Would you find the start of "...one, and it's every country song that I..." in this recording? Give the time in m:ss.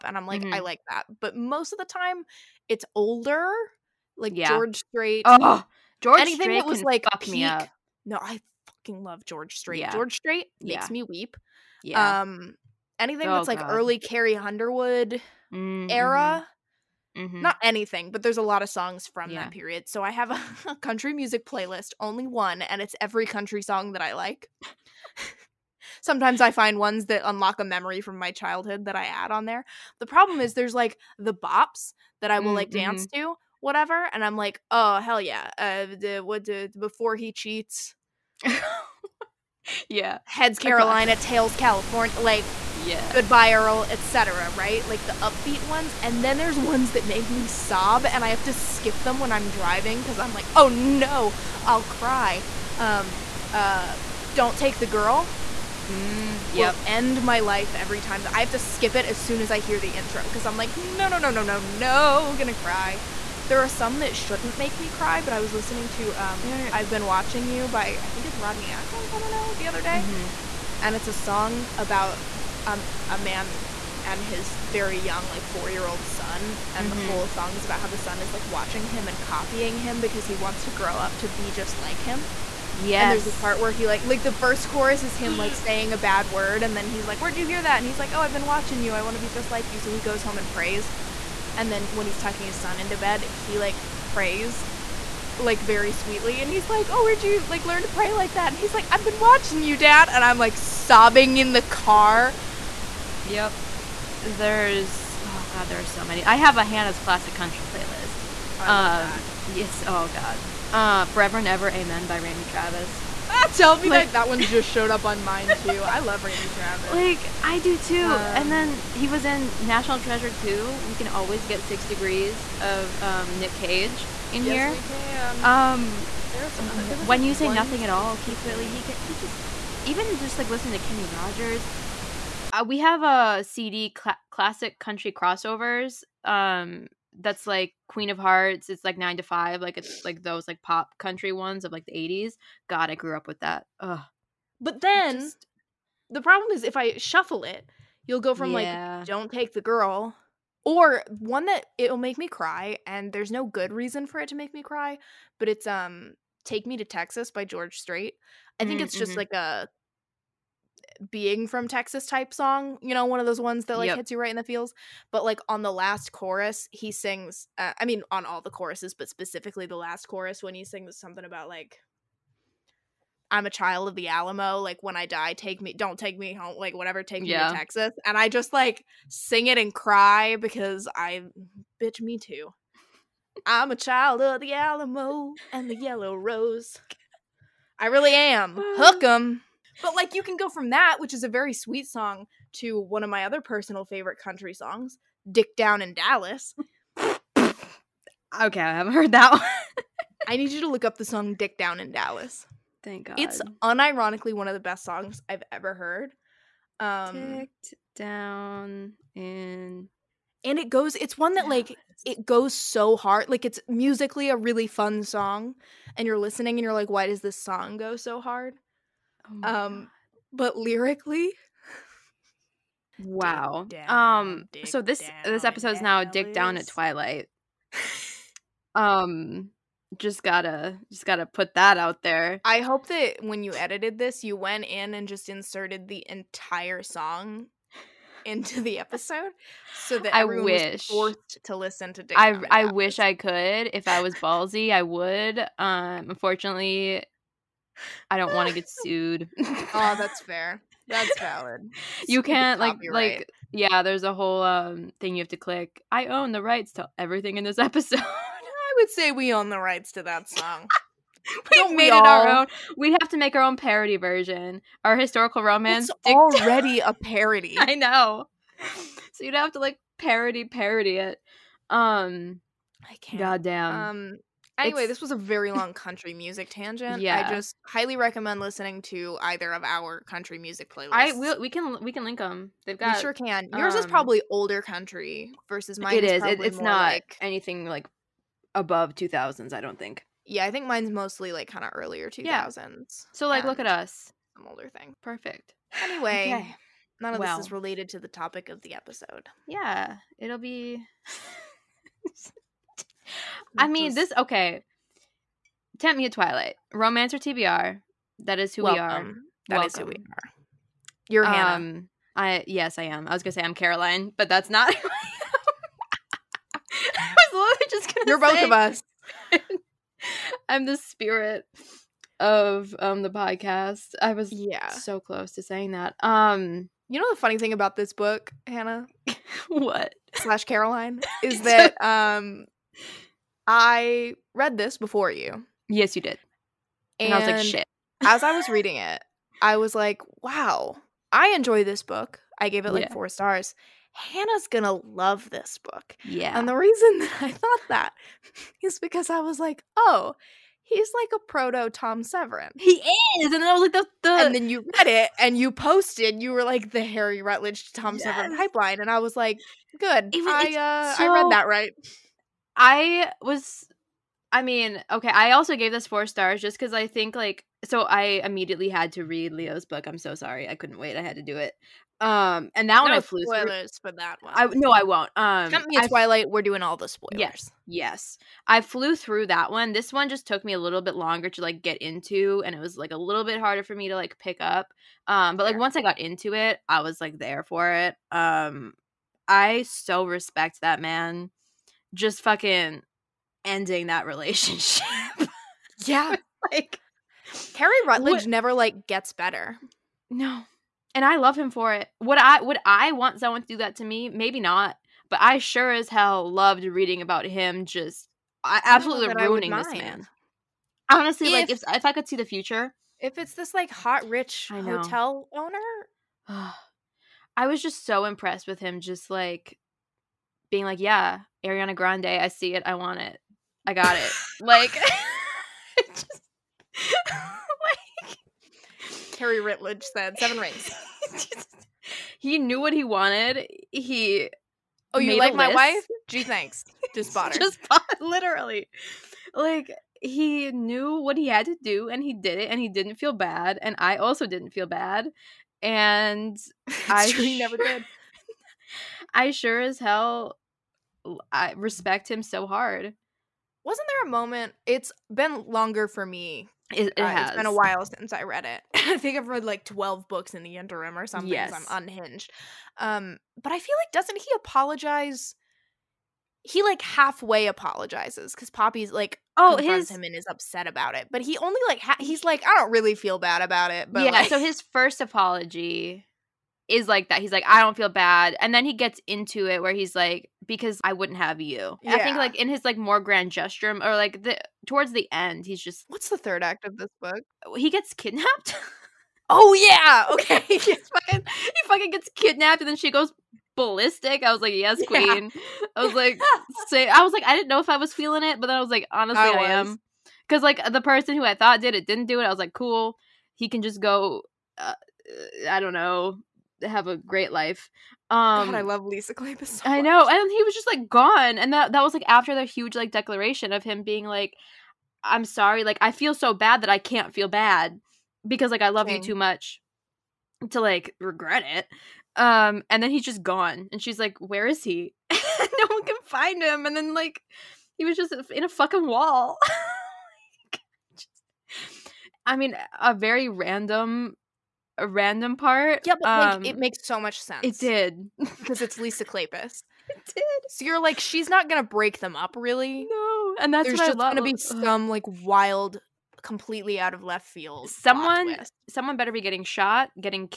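0:22.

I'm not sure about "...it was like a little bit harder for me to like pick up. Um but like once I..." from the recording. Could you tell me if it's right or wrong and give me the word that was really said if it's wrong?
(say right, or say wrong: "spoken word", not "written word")
right.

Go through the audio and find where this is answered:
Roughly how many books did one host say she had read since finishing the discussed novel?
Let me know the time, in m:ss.
7:39.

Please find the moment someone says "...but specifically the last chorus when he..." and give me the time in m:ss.
2:48.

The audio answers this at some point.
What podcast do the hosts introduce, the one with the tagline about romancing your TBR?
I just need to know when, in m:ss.
5:05.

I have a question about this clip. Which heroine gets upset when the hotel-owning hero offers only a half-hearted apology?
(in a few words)
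Poppy.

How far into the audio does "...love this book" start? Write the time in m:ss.
5:44.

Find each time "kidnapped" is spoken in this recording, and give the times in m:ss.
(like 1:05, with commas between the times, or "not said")
8:07, 8:12.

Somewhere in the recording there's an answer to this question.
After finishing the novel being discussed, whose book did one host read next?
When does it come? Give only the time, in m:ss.
6:09.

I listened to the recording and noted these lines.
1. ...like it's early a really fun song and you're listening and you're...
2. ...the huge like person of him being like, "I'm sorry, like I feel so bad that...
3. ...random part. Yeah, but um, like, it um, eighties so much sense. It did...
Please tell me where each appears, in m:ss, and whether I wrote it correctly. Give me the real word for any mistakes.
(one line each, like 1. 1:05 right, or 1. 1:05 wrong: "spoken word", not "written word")
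1. 3:33 wrong: "musically", not "early"
2. 8:32 wrong: "declaration", not "person"
3. 8:54 wrong: "makes", not "eighties".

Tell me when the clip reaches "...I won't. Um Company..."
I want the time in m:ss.
6:14.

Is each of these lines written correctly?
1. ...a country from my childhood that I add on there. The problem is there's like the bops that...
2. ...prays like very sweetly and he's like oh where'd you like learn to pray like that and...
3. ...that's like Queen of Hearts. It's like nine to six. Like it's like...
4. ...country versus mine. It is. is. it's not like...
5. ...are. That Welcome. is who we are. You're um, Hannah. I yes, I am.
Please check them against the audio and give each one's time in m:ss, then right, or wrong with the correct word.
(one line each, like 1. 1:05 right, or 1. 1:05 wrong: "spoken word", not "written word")
1. 0:27 wrong: "memory", not "country"
2. 1:34 right
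3. 2:17 wrong: "five", not "six"
4. 4:44 right
5. 5:08 right.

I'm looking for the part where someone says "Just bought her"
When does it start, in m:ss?
7:16.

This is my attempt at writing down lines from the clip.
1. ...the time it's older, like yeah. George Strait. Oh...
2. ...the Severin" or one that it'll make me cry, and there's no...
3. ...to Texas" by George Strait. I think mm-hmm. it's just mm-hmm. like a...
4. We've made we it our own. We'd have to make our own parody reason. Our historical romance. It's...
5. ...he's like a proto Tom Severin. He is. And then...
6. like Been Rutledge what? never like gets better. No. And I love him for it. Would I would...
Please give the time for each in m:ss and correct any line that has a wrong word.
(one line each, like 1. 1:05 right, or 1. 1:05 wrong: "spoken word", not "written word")
1. 0:01 right
2. 2:29 wrong: "Girl", not "Severin"
3. 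2:36 right
4. 4:21 wrong: "version", not "reason"
5. 5:50 right
6. 6:36 wrong: "Harry", not "Been".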